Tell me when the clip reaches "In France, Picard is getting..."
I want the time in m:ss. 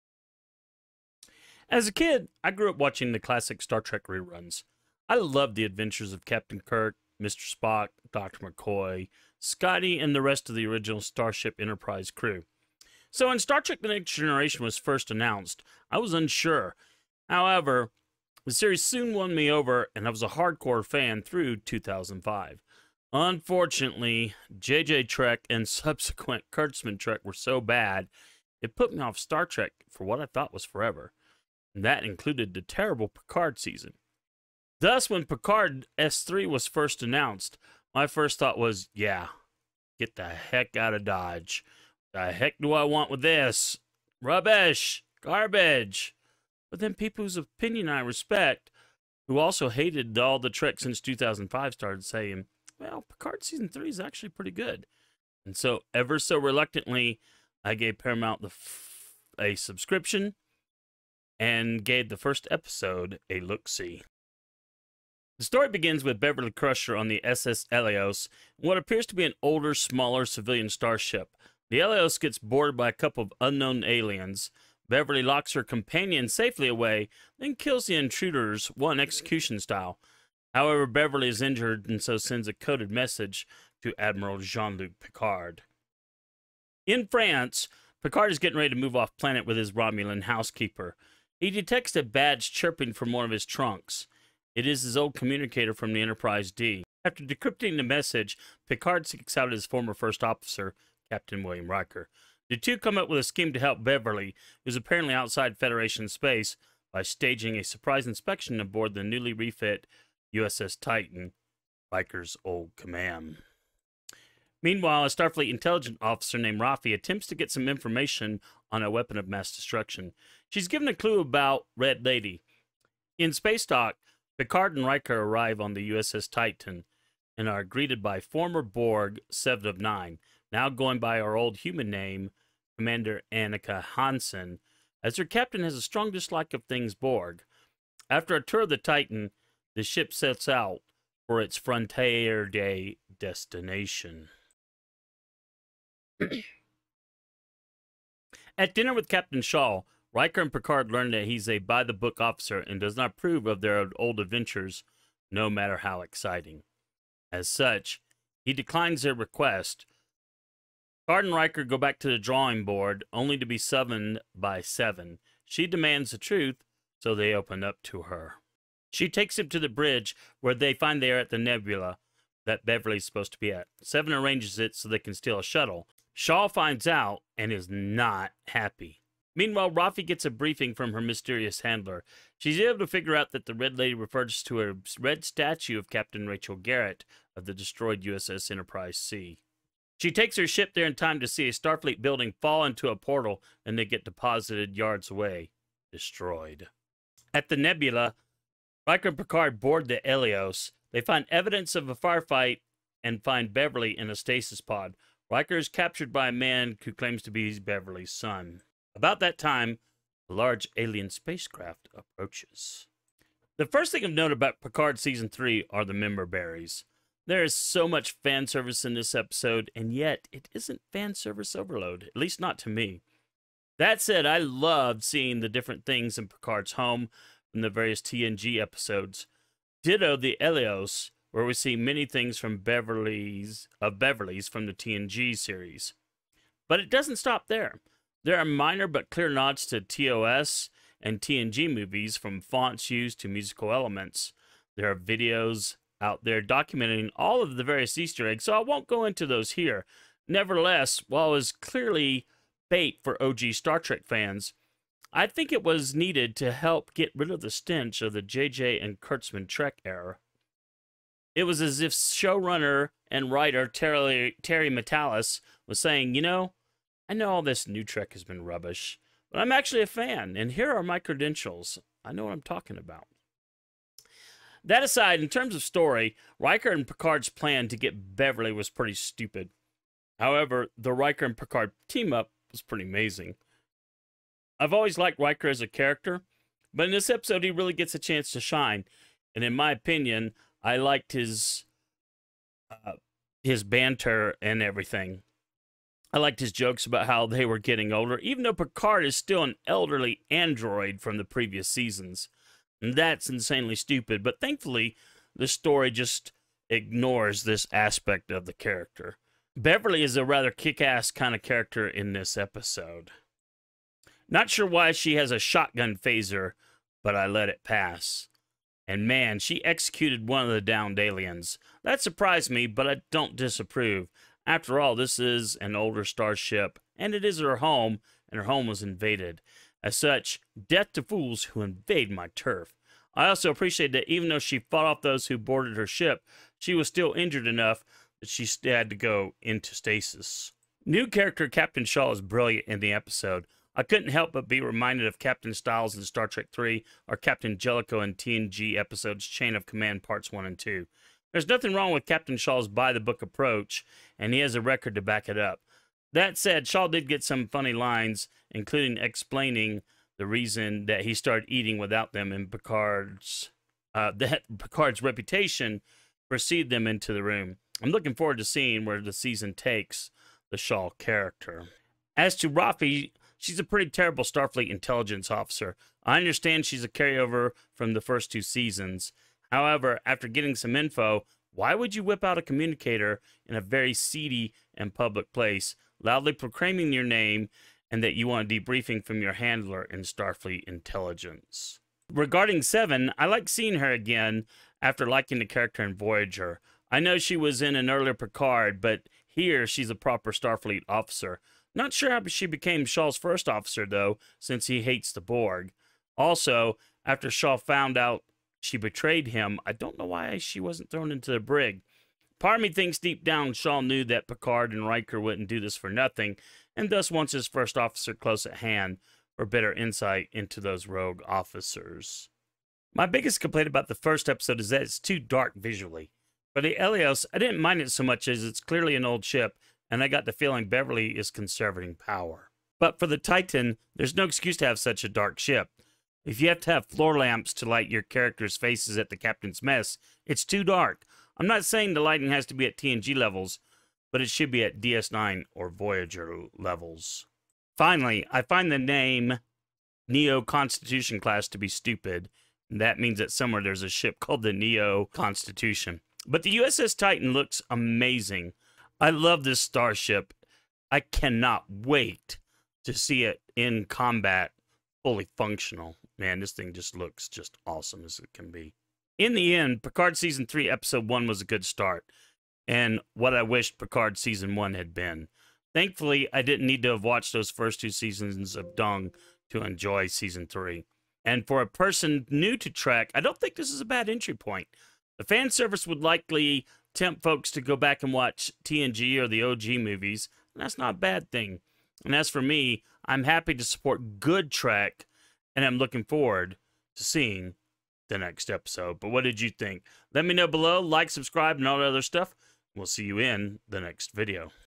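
1:26.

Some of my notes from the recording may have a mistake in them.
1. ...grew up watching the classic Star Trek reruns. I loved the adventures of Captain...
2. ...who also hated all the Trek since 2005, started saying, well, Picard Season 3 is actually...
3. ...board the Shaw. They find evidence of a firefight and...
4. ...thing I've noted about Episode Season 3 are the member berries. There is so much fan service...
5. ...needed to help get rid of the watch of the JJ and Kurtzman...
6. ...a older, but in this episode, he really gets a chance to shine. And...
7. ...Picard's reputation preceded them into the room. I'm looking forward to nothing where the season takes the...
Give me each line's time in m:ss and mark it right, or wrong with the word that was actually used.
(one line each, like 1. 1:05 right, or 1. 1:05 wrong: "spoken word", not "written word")
1. 0:02 right
2. 0:49 right
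3. 3:19 wrong: "Eleos", not "Shaw"
4. 3:33 wrong: "Picard", not "Episode"
5. 4:15 wrong: "stench", not "watch"
6. 4:45 wrong: "character", not "older"
7. 6:04 wrong: "seeing", not "nothing".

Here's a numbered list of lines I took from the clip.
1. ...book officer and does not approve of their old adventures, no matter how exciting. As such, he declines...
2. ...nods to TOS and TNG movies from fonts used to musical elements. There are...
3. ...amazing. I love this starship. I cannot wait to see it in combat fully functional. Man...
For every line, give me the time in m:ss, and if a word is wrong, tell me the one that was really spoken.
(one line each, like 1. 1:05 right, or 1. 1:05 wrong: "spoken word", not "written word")
1. 2:31 right
2. 3:59 right
3. 7:37 right.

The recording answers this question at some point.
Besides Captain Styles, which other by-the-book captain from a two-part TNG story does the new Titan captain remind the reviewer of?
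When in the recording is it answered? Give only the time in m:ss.
5:47.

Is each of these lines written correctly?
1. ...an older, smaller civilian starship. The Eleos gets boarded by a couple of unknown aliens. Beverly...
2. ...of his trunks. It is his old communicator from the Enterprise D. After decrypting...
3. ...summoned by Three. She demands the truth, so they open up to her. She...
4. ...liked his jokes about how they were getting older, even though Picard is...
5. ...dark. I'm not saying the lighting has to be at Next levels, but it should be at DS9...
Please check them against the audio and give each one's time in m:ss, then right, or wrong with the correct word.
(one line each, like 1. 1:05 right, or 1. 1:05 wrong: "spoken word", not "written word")
1. 1:09 right
2. 1:33 right
3. 2:43 wrong: "Seven", not "Three"
4. 4:56 right
5. 7:20 wrong: "TNG", not "Next".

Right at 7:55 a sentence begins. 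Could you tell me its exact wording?
Thankfully, I didn't need to have watched those first two seasons of Dung to enjoy Season 3.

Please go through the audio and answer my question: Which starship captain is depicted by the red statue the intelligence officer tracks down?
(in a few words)
Rachel Garrett.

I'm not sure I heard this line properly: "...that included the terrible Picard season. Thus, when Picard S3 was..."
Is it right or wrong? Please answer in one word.
right.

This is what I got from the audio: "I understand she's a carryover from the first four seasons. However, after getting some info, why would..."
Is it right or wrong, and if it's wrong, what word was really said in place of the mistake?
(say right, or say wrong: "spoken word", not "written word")
wrong: "two", not "four".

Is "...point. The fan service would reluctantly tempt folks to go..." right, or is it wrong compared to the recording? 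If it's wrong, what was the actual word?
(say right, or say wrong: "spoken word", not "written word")
wrong: "likely", not "reluctantly".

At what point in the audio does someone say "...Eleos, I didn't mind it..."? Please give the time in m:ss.
7:06.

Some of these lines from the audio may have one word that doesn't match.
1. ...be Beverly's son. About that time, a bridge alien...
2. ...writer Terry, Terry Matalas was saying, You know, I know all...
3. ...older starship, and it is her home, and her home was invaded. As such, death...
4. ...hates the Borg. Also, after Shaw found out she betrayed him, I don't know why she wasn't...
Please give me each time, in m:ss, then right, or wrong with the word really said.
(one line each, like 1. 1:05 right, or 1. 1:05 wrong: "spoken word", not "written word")
1. 3:27 wrong: "large", not "bridge"
2. 4:23 right
3. 5:25 right
4. 6:44 right.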